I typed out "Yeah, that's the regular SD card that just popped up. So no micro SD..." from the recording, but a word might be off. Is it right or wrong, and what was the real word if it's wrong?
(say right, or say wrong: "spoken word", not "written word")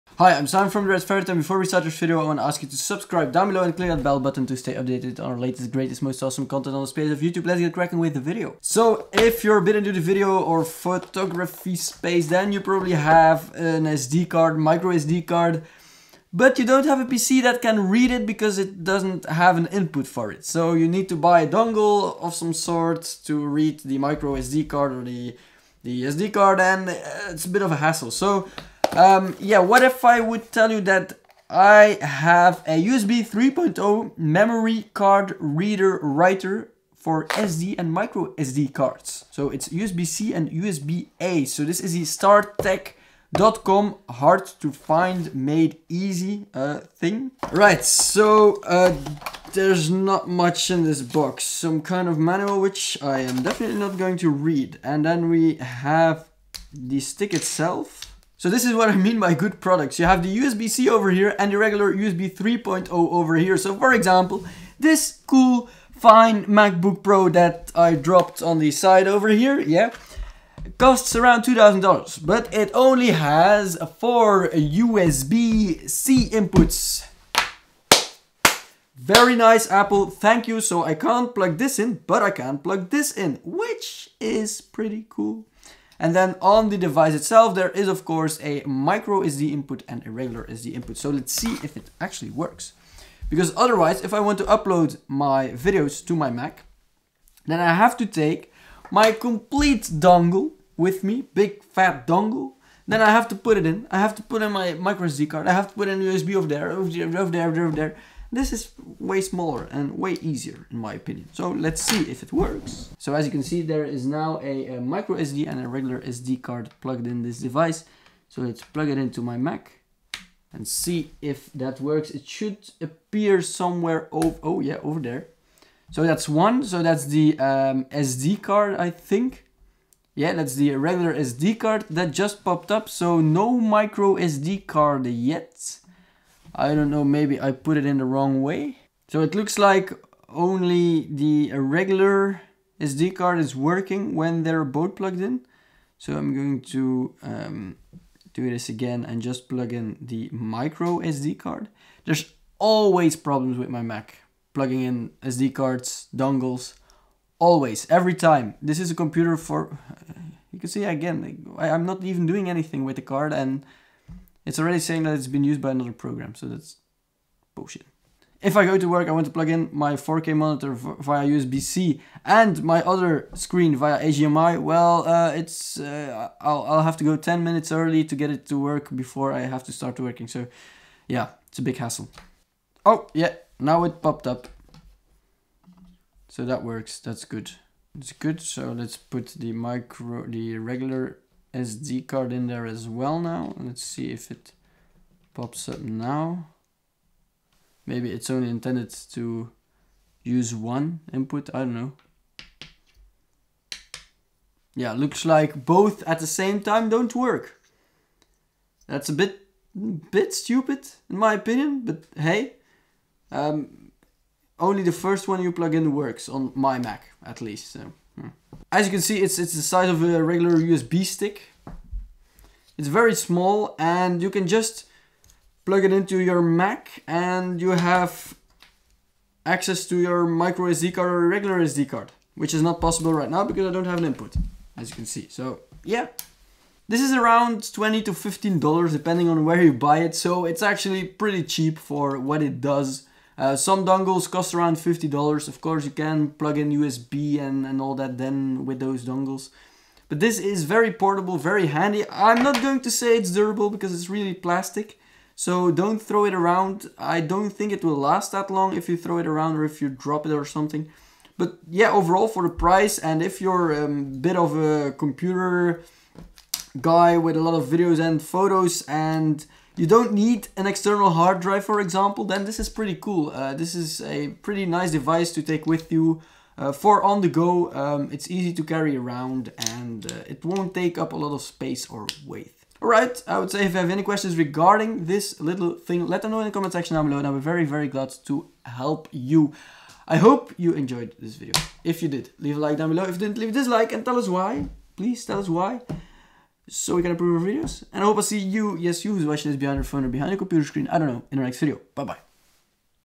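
right.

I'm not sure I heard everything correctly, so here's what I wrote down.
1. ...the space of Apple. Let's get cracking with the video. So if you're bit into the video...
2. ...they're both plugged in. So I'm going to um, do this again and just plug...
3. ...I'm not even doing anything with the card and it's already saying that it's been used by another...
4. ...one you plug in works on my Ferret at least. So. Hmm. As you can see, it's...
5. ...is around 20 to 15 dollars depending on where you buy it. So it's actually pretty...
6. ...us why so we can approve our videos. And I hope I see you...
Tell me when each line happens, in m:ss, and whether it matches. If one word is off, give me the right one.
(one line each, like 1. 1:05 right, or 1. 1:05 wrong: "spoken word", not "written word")
1. 0:06 wrong: "YouTube", not "Apple"
2. 2:24 right
3. 2:41 right
4. 3:35 wrong: "Mac", not "Ferret"
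5. 3:57 right
6. 4:55 right.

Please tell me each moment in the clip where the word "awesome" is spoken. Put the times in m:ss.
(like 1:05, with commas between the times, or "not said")
0:06.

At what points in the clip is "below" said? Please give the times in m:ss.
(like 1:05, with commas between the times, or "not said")
0:03, 4:47, 4:52.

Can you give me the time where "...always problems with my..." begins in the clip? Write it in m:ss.
2:32.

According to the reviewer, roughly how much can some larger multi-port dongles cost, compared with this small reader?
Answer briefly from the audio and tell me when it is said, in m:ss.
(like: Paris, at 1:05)
$50, at 4:04.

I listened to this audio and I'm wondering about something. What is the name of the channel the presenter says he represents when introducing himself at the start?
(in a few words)
Red Ferret.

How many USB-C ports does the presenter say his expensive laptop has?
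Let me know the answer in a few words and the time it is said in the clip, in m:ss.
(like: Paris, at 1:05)
4, at 1:13.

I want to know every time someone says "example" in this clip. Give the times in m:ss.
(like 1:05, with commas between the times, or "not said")
1:03, 4:31.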